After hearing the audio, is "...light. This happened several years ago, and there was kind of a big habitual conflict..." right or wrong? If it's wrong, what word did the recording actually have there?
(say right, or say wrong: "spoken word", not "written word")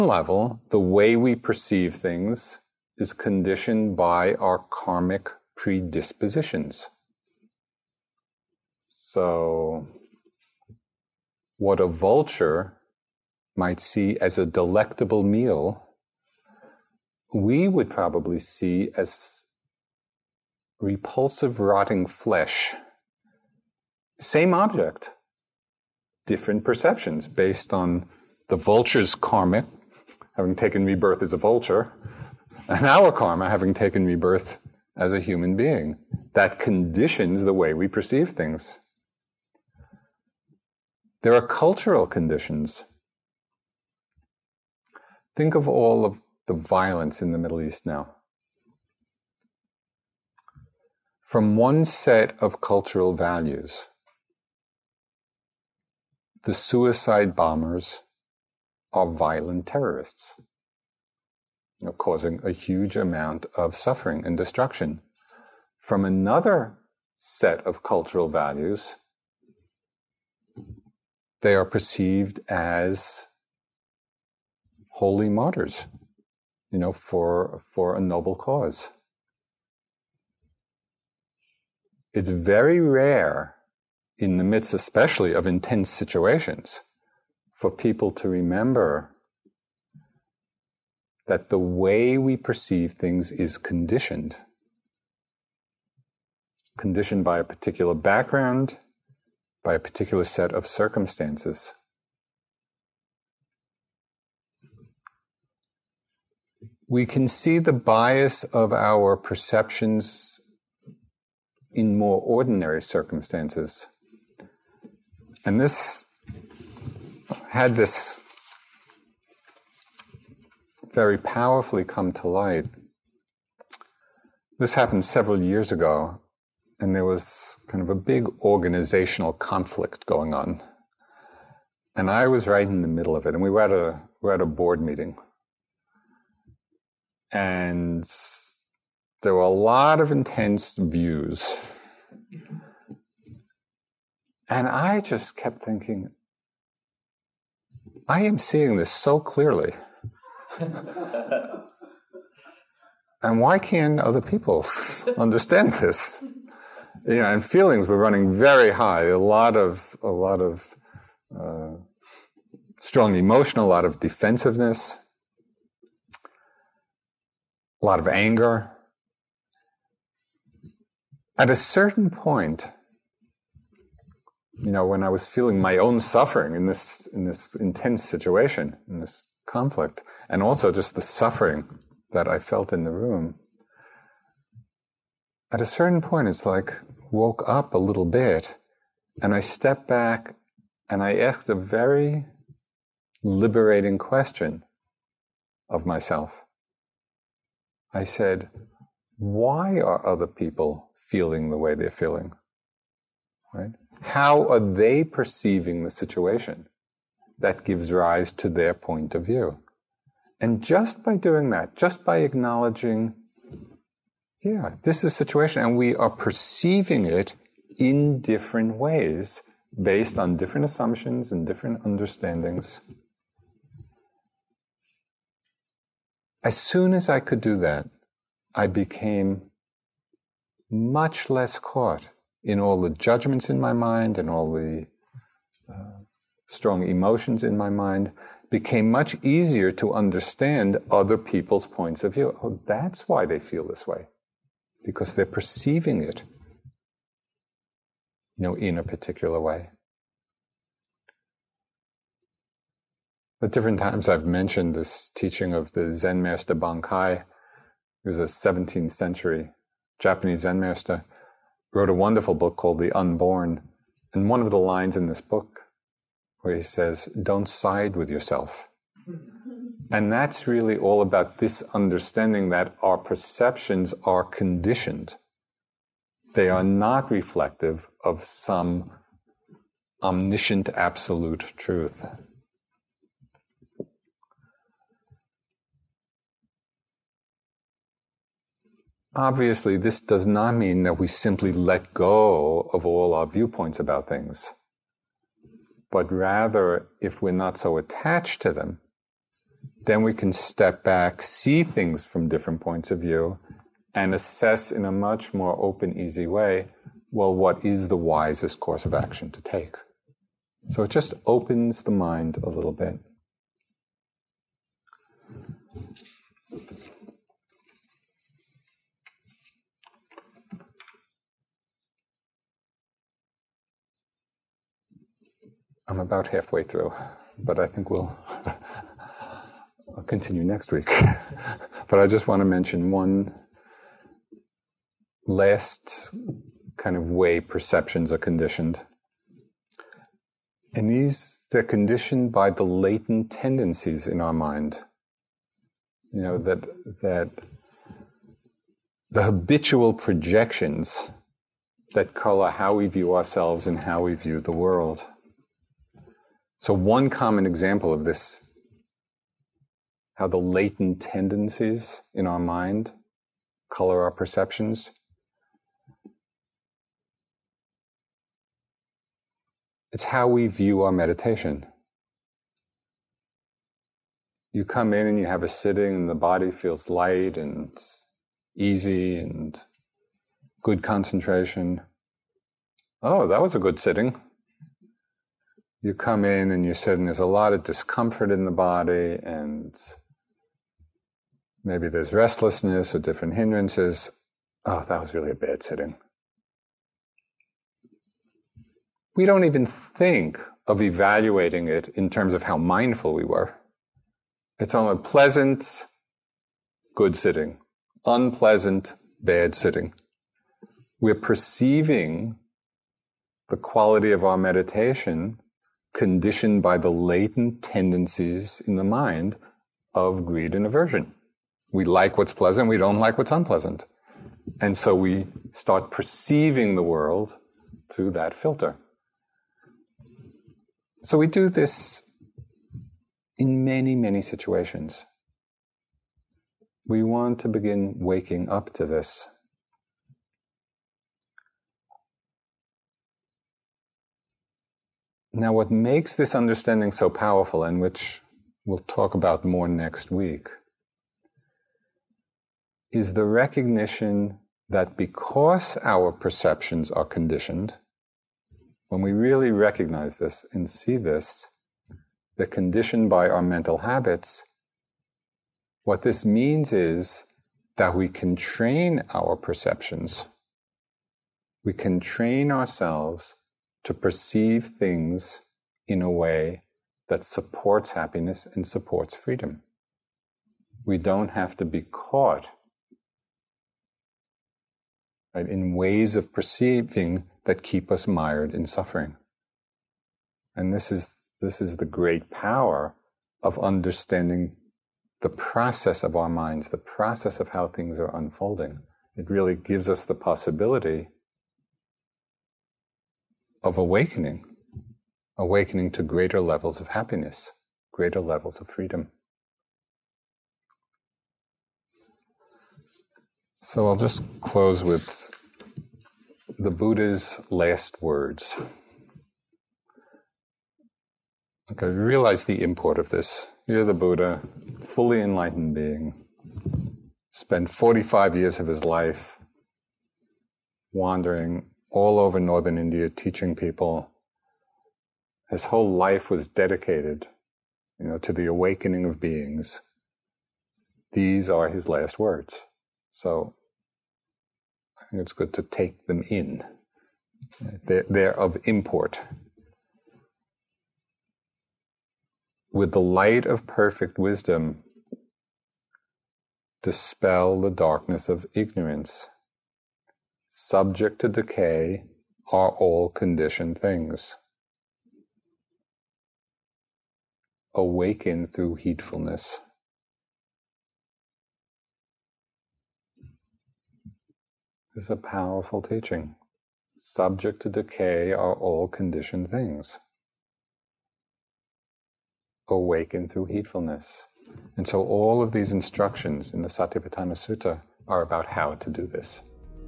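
wrong: "organizational", not "habitual".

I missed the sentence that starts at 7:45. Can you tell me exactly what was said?
What this means is that we can train our perceptions.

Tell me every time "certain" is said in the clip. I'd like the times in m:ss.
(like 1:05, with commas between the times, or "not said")
2:51, 3:05.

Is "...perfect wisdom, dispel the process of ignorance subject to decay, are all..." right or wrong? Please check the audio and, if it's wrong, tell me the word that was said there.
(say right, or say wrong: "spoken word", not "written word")
wrong: "darkness", not "process".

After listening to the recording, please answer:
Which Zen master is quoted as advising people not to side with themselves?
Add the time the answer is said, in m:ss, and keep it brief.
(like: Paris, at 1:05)
Bankei, at 4:16.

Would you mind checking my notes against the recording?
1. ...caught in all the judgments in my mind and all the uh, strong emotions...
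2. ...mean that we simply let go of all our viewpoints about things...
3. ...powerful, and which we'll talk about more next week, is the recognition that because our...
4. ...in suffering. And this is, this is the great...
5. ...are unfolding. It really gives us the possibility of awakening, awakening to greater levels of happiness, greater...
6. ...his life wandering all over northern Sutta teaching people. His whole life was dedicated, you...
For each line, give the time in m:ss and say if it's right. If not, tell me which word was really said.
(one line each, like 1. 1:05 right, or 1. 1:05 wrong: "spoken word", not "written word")
1. 3:51 right
2. 4:50 right
3. 7:27 right
4. 8:08 right
5. 8:17 right
6. 8:48 wrong: "India", not "Sutta".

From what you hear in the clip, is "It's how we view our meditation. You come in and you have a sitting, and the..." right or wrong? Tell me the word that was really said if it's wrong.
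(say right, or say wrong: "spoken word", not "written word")
right.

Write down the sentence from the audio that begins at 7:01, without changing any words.
We like what's pleasant, we don't like what's unpleasant.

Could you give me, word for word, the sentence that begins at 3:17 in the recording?
I said, why are other people feeling the way they're feeling?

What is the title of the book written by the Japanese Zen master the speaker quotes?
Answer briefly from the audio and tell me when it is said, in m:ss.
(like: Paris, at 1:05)
The Unborn, at 4:22.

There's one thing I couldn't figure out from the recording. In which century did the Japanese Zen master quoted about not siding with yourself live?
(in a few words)
17th century.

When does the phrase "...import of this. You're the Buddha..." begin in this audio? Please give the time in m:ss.
8:42.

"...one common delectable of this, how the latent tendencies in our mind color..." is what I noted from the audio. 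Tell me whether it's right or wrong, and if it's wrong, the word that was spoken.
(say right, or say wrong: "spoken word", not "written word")
wrong: "example", not "delectable".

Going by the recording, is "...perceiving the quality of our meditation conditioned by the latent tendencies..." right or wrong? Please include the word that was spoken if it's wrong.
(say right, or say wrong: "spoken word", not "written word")
right.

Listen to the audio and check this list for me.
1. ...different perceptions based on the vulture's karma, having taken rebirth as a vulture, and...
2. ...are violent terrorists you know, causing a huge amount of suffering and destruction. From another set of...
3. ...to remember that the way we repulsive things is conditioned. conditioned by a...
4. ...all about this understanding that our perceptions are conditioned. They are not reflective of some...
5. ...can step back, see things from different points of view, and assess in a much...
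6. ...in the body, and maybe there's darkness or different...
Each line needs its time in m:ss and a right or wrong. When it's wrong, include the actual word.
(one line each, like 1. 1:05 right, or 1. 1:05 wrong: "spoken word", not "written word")
1. 0:26 right
2. 0:58 right
3. 1:28 wrong: "perceive", not "repulsive"
4. 4:30 right
5. 5:00 right
6. 6:28 wrong: "restlessness", not "darkness".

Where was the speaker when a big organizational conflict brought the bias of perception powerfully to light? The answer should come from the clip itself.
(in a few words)
Board meeting.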